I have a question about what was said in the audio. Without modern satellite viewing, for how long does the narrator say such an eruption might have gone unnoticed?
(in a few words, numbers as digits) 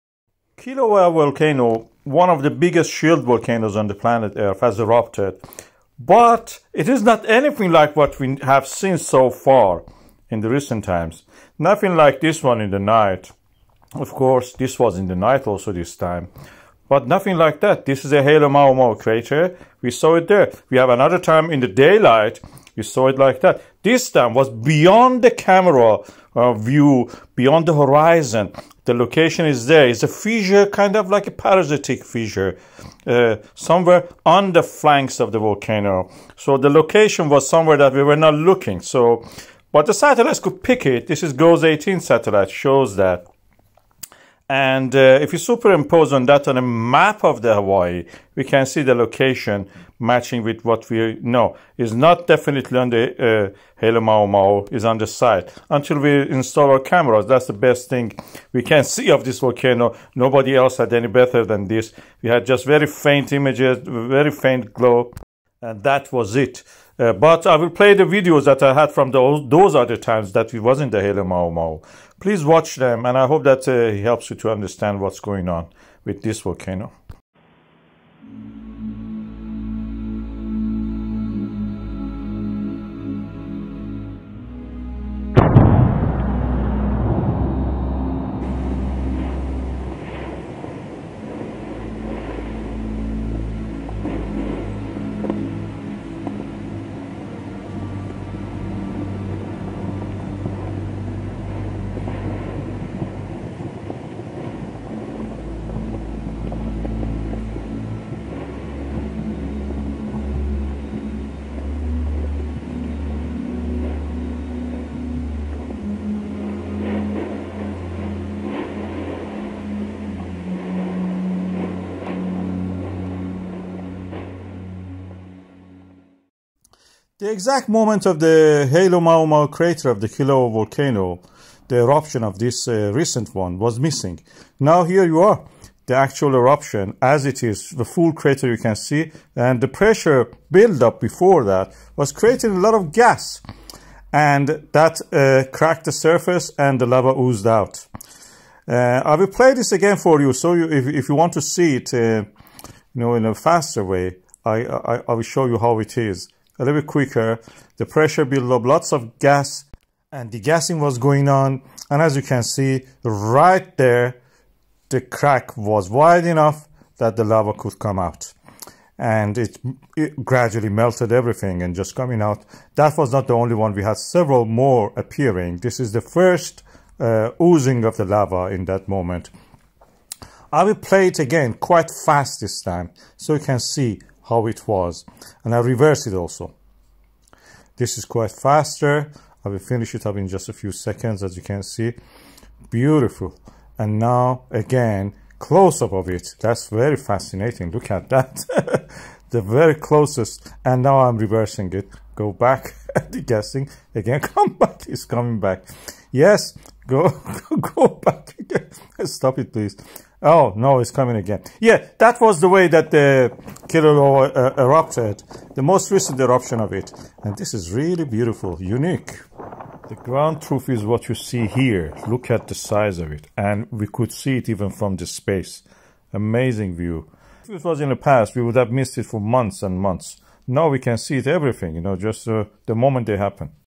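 Months and months.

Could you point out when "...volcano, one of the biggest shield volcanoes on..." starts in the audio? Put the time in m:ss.
0:01.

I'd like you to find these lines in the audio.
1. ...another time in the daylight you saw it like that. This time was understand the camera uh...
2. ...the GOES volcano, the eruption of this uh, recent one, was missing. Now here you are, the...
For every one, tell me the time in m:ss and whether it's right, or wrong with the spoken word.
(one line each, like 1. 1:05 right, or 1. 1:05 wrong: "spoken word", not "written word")
1. 0:20 wrong: "beyond", not "understand"
2. 2:10 wrong: "Kilauea", not "GOES".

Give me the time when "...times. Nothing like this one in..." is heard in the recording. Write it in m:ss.
0:10.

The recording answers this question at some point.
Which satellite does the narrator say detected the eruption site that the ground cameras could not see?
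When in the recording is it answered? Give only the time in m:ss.
0:41.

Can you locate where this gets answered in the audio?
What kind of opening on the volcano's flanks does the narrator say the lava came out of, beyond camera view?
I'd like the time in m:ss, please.
0:31.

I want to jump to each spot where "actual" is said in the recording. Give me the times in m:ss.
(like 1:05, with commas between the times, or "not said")
2:15.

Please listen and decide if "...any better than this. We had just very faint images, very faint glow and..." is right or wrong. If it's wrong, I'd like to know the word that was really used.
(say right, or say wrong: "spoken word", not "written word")
right.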